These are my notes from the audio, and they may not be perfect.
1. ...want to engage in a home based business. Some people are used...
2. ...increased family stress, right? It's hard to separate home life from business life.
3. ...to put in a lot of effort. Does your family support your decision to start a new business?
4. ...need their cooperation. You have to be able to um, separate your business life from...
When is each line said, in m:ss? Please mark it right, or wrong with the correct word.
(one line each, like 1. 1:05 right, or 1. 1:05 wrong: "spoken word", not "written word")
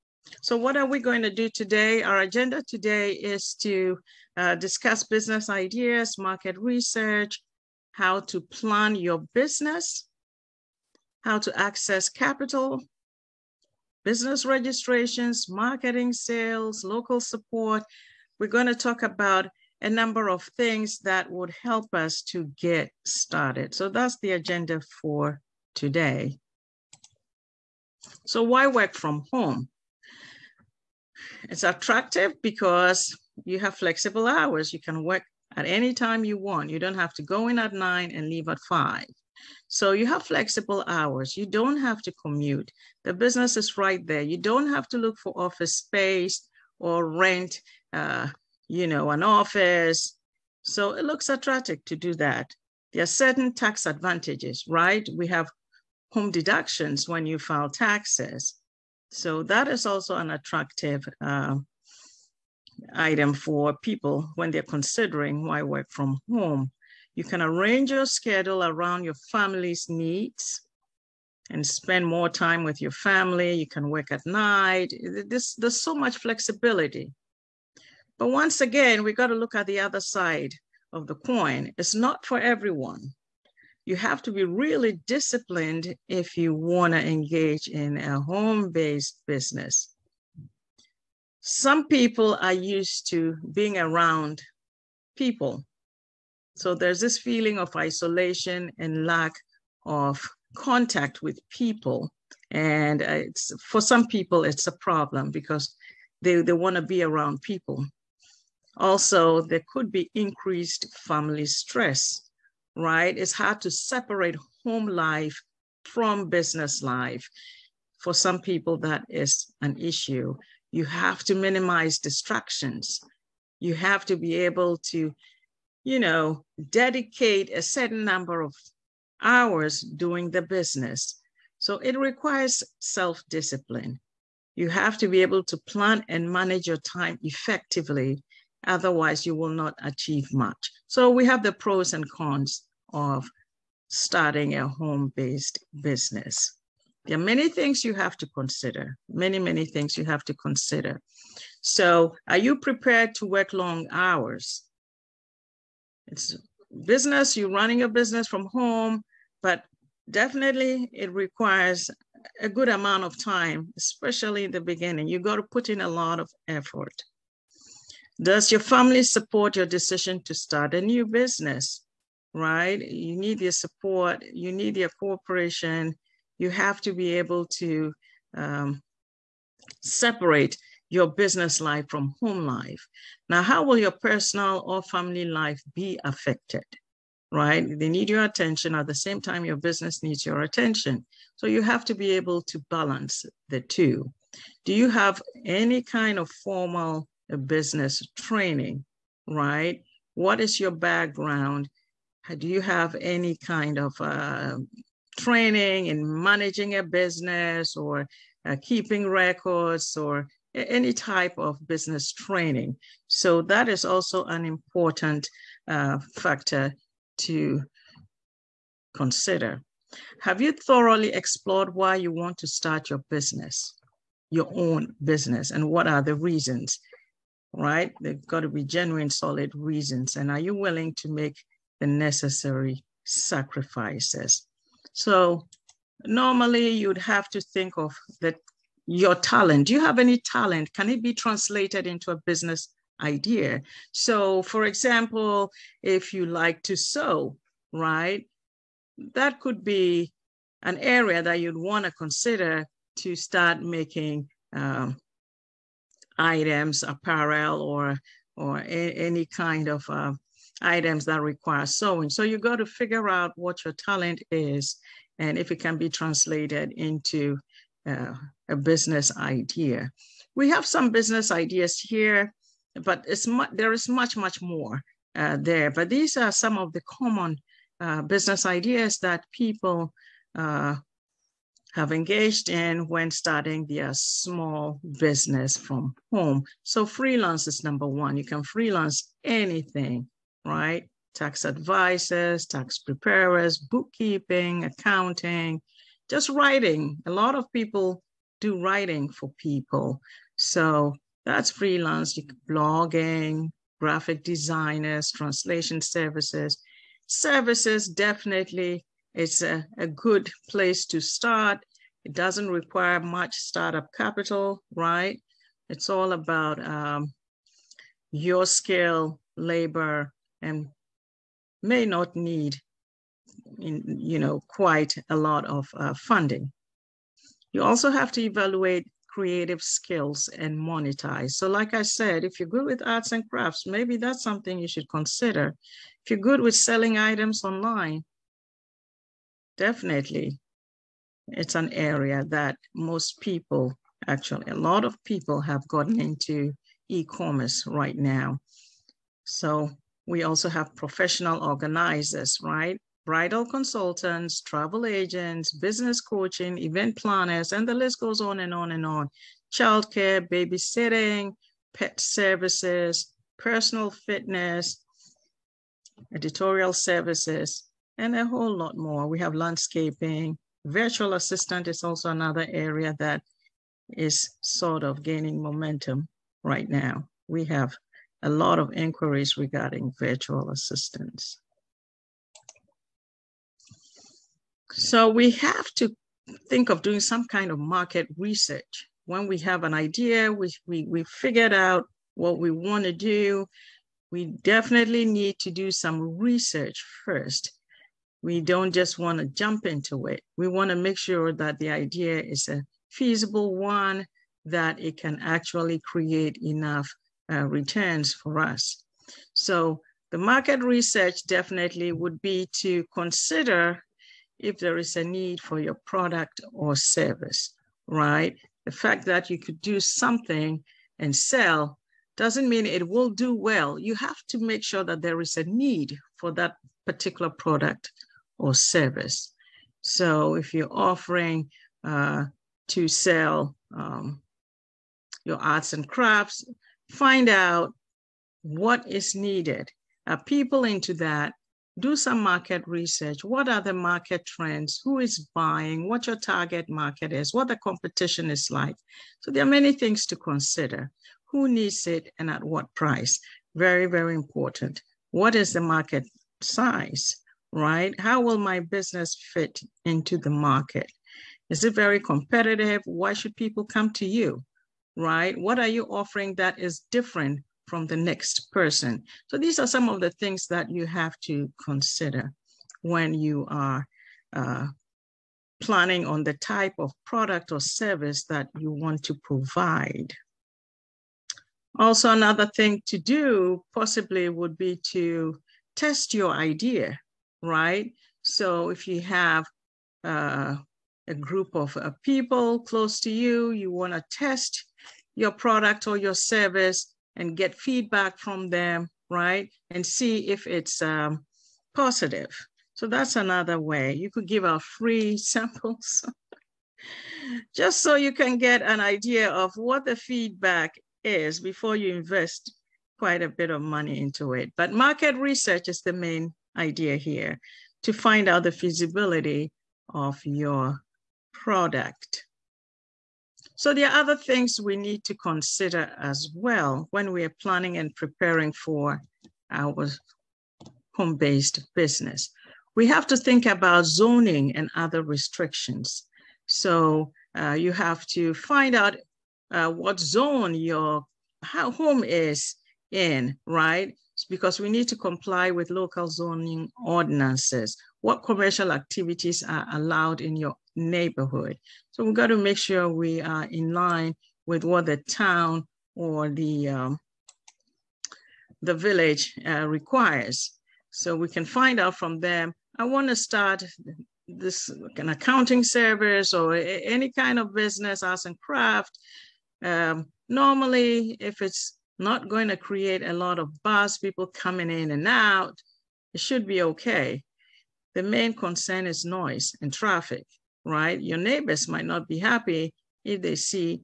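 1. 1:26 right
2. 1:50 right
3. 2:45 right
4. 2:54 right.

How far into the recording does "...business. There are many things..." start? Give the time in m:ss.
2:25.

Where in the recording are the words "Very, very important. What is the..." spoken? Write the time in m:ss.
7:33.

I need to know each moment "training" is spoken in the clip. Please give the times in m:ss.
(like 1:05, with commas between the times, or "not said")
3:18, 3:25, 3:32.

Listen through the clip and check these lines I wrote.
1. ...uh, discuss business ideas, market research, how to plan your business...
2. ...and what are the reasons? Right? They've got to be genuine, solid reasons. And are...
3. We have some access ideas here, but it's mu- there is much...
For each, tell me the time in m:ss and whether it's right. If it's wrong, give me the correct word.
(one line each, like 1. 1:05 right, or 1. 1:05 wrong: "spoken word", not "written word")
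1. 0:04 right
2. 3:45 right
3. 4:30 wrong: "business", not "access".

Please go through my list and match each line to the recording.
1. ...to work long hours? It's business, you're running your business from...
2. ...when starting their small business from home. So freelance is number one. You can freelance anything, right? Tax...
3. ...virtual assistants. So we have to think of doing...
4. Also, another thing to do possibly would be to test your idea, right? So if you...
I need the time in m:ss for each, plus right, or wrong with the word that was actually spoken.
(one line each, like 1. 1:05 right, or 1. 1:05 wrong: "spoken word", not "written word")
1. 2:33 right
2. 4:42 right
3. 6:19 right
4. 8:01 right.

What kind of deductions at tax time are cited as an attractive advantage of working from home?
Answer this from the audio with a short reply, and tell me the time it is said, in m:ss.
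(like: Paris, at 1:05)
Home deductions, at 0:56.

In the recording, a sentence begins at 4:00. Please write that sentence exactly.
Can it be translated into a business idea?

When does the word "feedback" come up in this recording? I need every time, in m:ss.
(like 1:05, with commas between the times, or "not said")
8:17, 8:29.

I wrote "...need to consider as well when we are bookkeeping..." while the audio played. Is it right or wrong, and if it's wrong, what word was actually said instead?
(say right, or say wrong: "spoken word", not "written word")
wrong: "planning", not "bookkeeping".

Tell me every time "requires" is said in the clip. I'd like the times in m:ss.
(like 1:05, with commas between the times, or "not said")
2:11, 2:41, 4:21, 5:12, 9:19.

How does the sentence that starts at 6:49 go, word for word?
So the market research definitely would be to consider if there is a need for your product or service, right?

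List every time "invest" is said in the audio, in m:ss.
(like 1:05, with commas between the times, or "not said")
8:31.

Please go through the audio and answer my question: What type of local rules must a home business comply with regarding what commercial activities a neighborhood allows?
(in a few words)
Zoning ordinances.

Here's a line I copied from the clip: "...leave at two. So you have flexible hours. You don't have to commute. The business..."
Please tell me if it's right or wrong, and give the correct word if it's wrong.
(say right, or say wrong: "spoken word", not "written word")
wrong: "five", not "two".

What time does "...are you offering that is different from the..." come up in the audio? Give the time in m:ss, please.
7:45.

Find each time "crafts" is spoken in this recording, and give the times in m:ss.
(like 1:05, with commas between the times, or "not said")
5:33, 7:15, 9:28.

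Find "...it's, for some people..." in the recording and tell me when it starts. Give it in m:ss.
1:43.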